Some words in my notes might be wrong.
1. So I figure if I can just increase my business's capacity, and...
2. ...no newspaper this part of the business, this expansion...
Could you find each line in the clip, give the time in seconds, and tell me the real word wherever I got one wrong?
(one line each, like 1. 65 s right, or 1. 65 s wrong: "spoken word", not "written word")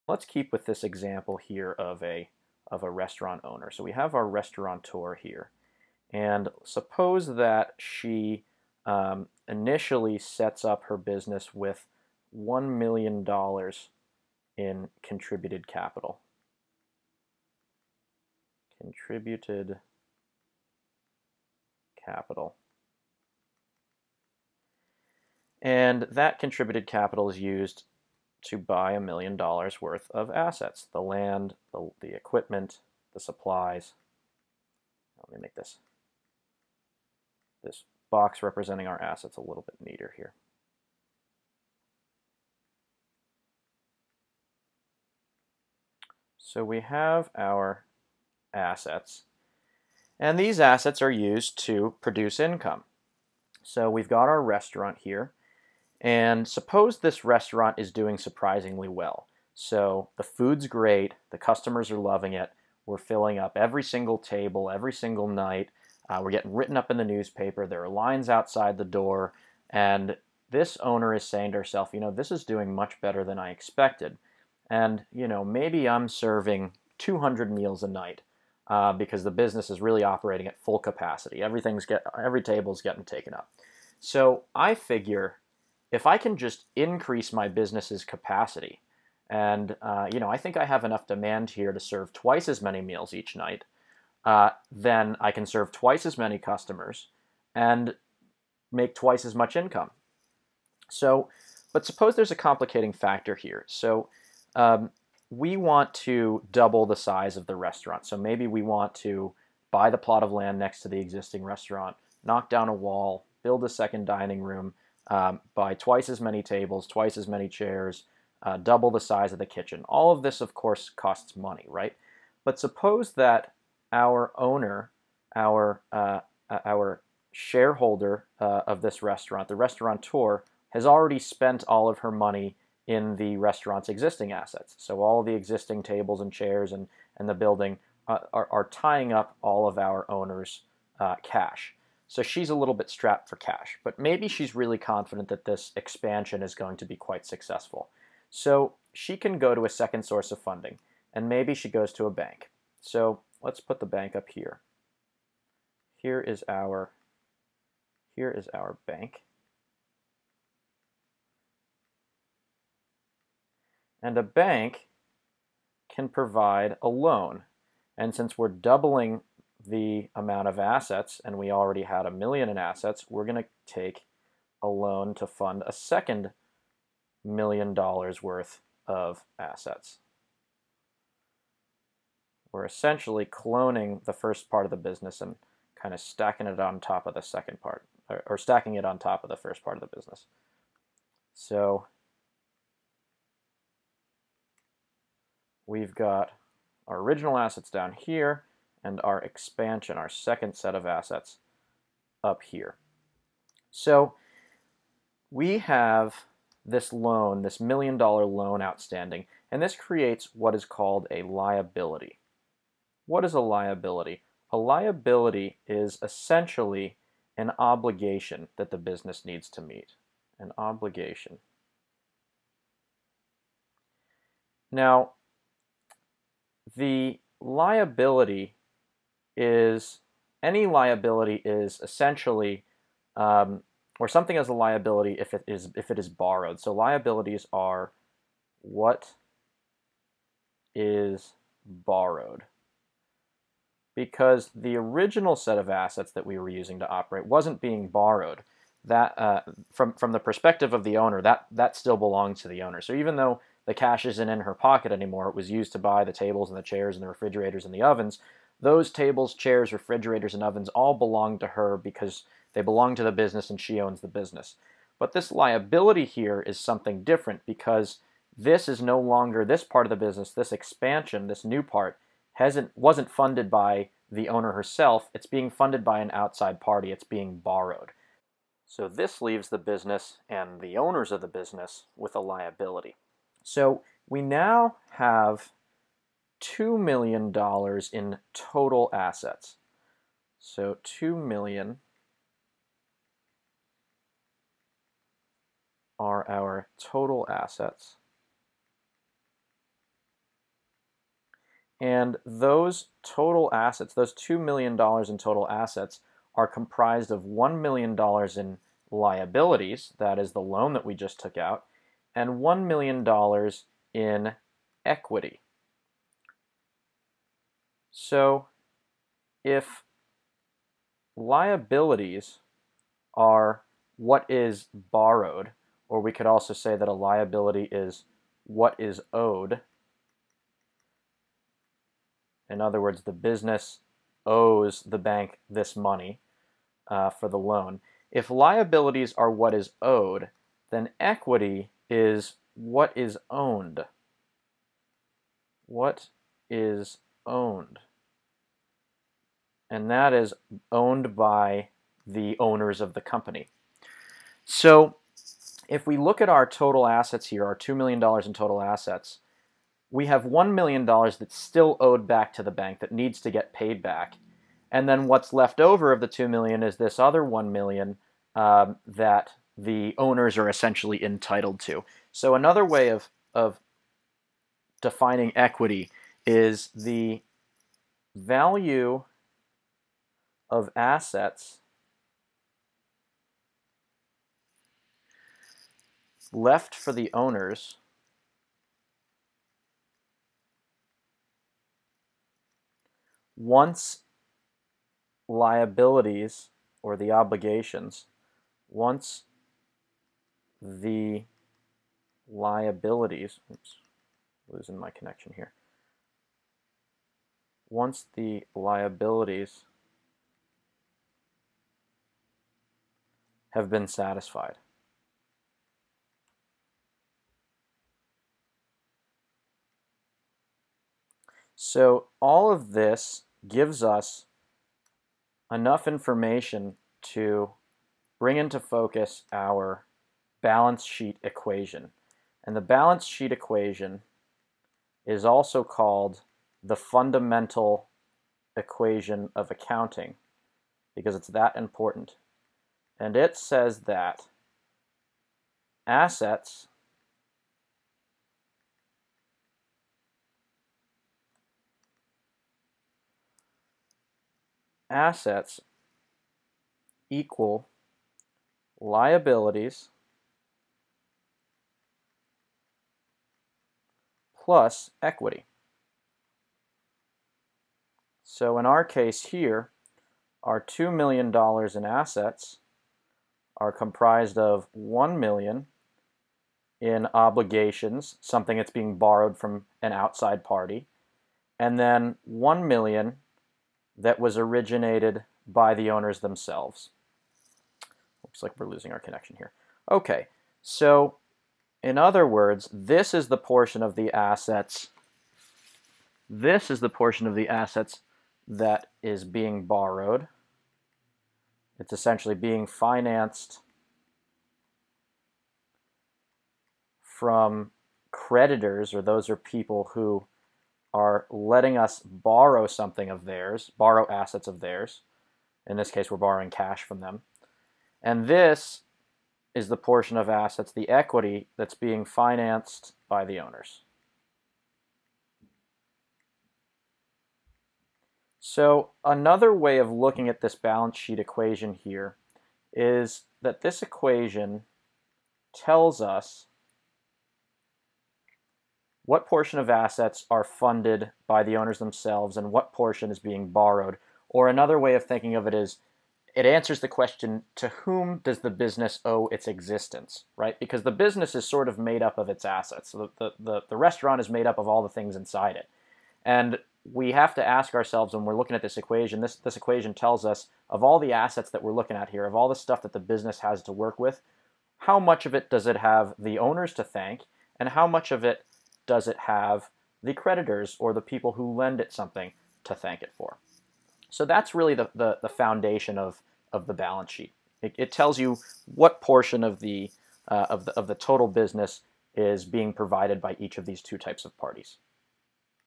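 1. 83 s right
2. 268 s wrong: "longer", not "newspaper".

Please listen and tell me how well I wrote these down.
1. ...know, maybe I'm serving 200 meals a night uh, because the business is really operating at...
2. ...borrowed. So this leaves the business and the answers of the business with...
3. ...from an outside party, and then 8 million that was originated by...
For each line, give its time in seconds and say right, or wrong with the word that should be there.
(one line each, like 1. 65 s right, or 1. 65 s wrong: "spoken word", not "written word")
1. 75 s right
2. 277 s wrong: "owners", not "answers"
3. 479 s wrong: "1", not "8".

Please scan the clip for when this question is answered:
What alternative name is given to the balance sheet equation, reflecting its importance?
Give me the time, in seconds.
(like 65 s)
436 s.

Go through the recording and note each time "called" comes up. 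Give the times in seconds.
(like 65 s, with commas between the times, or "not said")
210 s, 435 s.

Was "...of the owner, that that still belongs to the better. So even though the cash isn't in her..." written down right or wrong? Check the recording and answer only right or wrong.
wrong.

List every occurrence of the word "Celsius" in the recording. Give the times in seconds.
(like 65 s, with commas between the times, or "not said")
not said.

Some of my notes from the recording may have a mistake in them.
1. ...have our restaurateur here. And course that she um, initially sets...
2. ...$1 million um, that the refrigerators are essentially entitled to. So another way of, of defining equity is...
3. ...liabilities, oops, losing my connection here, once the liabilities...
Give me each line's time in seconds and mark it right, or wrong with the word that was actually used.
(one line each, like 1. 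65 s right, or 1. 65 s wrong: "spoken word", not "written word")
1. 3 s wrong: "suppose", not "course"
2. 367 s wrong: "owners", not "refrigerators"
3. 402 s right.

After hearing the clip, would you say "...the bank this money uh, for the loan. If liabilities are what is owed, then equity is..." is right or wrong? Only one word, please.
right.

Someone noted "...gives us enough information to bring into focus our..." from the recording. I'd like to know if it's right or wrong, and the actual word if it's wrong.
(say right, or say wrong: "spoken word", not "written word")
right.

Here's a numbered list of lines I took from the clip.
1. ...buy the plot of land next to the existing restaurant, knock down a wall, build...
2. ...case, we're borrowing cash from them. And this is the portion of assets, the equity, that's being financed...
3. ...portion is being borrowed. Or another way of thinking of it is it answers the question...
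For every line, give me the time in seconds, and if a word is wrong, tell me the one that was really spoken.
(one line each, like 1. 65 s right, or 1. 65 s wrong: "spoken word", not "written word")
1. 109 s right
2. 515 s right
3. 542 s right.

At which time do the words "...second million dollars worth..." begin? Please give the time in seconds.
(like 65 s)
175 s.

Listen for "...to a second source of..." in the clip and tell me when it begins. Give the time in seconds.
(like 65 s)
149 s.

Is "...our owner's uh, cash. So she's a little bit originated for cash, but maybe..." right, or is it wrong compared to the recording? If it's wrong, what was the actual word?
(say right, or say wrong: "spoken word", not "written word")
wrong: "strapped", not "originated".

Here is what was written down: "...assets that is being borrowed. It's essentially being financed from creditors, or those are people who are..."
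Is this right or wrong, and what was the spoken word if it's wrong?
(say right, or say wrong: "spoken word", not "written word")
right.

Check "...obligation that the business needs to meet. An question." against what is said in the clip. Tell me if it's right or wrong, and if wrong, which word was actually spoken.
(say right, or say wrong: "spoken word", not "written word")
wrong: "obligation", not "question".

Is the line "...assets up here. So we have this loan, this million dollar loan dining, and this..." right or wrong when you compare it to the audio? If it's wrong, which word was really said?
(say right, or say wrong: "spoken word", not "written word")
wrong: "outstanding", not "dining".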